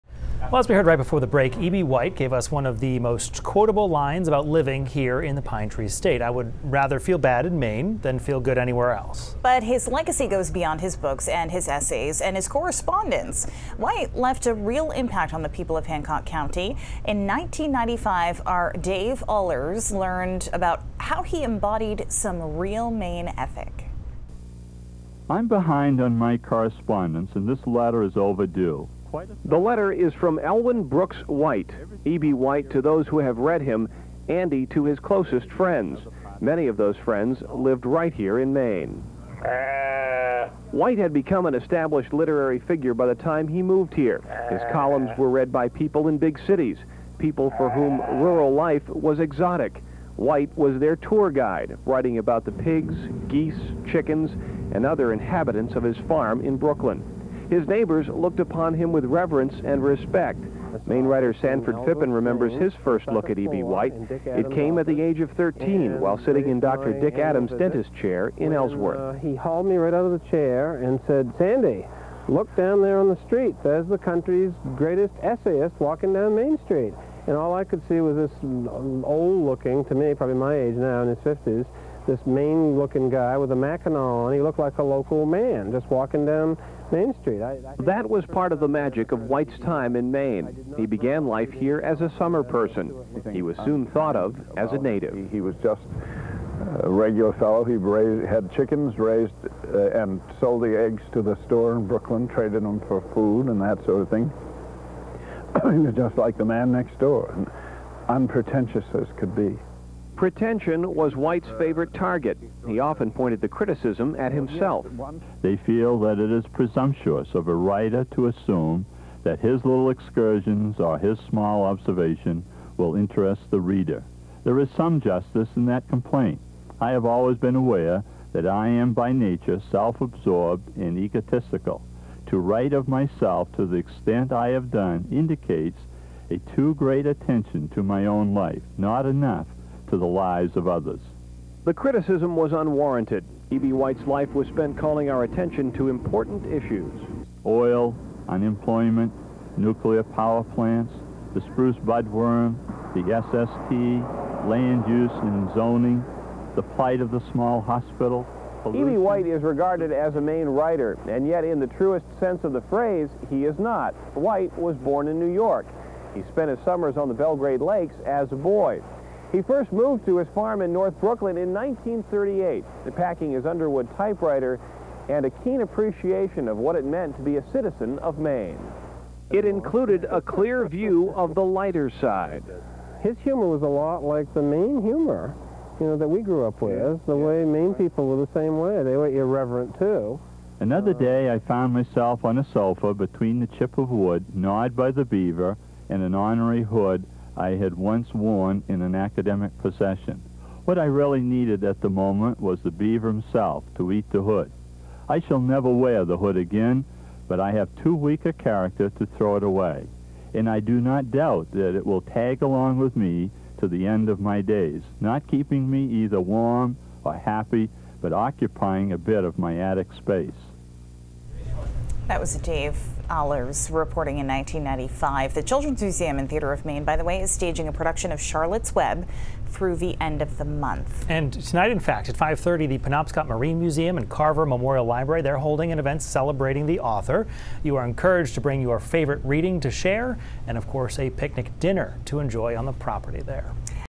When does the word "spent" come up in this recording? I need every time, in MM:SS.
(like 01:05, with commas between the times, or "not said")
02:24, 02:46.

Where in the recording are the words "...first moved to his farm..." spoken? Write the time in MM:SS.
02:49.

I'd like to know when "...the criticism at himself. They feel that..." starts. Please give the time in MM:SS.
01:53.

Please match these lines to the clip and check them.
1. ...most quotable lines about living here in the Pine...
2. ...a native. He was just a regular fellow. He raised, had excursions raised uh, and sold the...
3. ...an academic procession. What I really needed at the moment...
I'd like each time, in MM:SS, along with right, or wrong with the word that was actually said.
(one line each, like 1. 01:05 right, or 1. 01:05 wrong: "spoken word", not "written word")
1. 00:02 right
2. 01:34 wrong: "chickens", not "excursions"
3. 03:18 right.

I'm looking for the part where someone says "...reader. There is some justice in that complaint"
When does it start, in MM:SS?
02:03.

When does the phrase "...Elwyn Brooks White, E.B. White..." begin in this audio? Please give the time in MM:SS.
00:30.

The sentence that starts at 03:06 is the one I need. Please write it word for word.
Yeah, the yeah, way Maine right.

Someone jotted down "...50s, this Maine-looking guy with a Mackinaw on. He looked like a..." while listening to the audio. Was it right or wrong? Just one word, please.
right.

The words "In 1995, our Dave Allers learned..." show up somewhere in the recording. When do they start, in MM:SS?
00:17.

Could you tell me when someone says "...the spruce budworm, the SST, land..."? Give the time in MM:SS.
02:31.